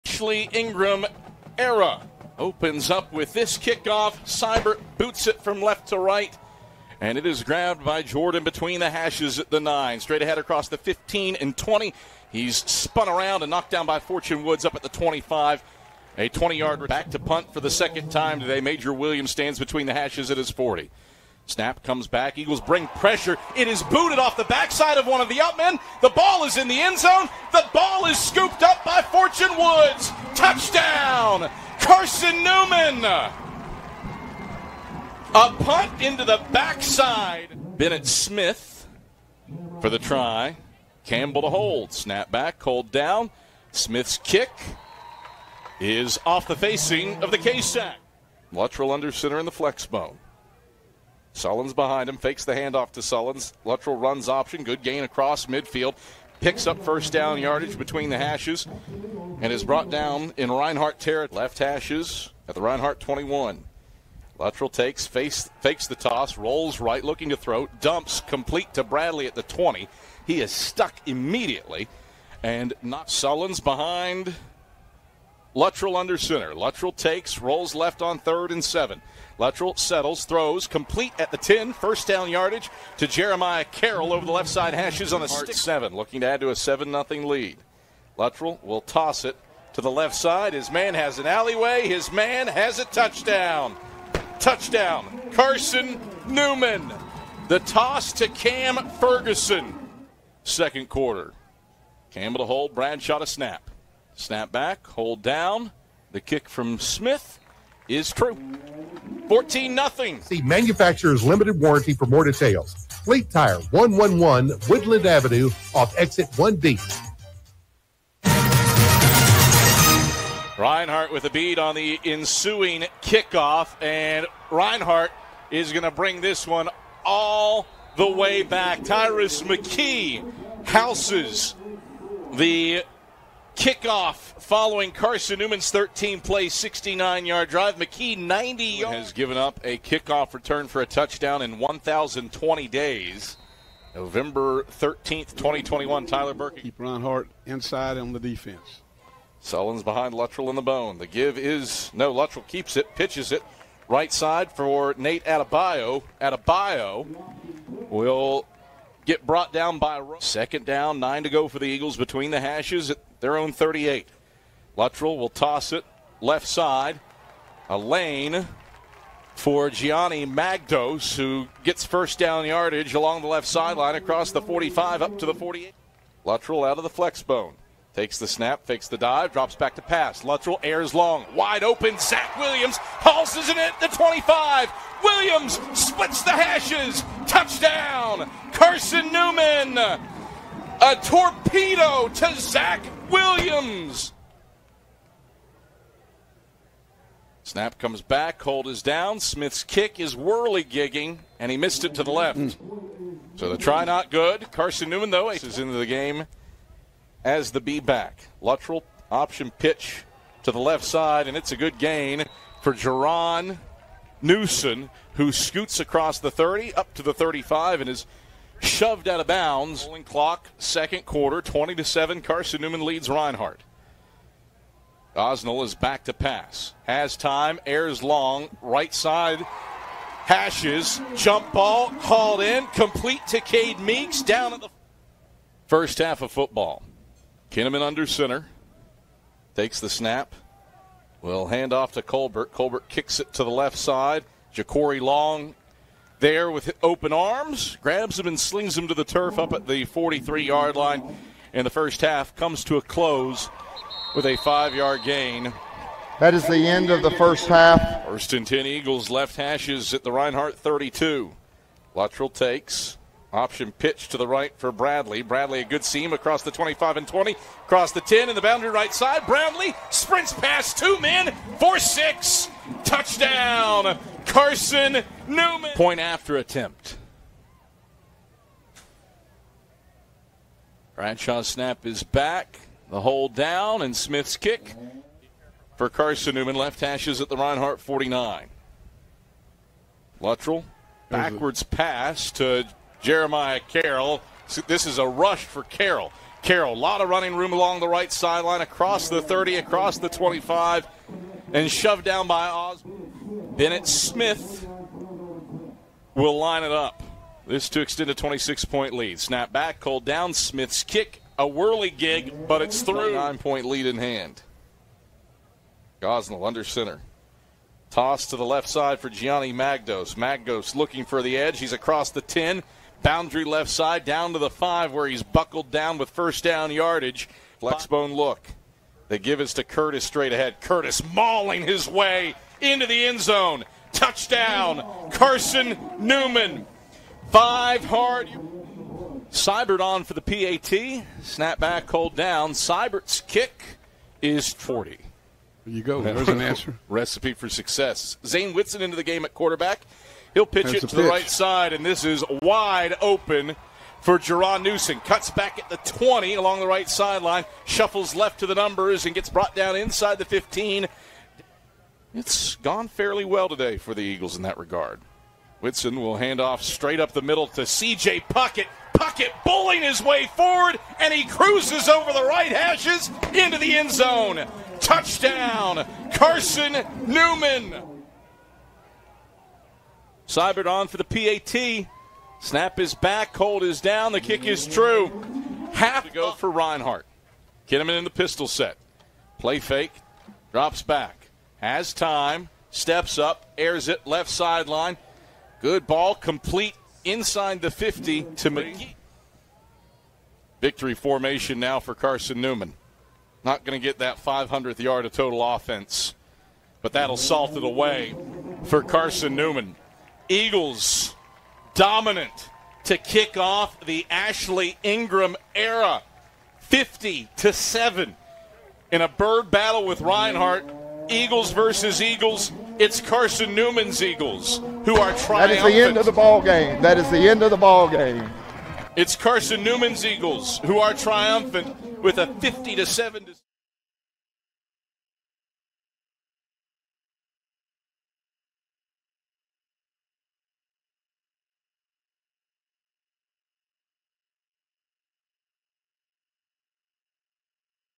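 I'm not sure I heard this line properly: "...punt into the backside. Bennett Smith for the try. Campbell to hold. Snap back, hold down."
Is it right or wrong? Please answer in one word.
right.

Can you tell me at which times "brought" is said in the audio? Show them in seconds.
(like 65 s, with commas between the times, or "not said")
59 s, 159 s, 359 s.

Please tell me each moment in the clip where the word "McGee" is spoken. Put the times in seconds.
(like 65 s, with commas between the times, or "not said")
398 s.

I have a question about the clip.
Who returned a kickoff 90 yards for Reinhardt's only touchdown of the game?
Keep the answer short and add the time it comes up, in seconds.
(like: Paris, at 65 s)
Tyrus McKee, at 128 s.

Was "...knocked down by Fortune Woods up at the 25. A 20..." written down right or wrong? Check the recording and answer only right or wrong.
right.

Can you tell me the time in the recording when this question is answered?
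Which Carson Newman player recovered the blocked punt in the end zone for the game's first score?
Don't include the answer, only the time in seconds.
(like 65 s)
29 s.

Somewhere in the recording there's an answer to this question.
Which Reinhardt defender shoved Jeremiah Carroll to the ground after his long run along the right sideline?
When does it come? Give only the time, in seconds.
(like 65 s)
302 s.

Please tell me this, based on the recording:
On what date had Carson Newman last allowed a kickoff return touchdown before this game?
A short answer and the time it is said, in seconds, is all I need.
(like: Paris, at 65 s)
November 13th, 2021, at 143 s.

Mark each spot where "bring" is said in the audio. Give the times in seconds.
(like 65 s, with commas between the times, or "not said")
22 s, 125 s.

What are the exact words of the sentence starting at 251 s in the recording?
And the first half comes to a close with a five yard gain.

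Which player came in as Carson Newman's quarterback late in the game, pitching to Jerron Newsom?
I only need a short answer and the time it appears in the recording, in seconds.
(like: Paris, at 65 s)
Zane Whitson, at 348 s.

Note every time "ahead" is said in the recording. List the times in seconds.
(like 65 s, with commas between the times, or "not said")
10 s, 330 s.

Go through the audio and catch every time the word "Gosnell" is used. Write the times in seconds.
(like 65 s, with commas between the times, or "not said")
316 s.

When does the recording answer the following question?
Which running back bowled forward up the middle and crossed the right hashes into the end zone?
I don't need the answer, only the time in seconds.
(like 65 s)
367 s.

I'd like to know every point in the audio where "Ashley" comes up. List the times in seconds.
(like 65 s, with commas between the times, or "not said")
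0 s, 414 s.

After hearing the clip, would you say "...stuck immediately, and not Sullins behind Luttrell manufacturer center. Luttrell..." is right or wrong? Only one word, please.
wrong.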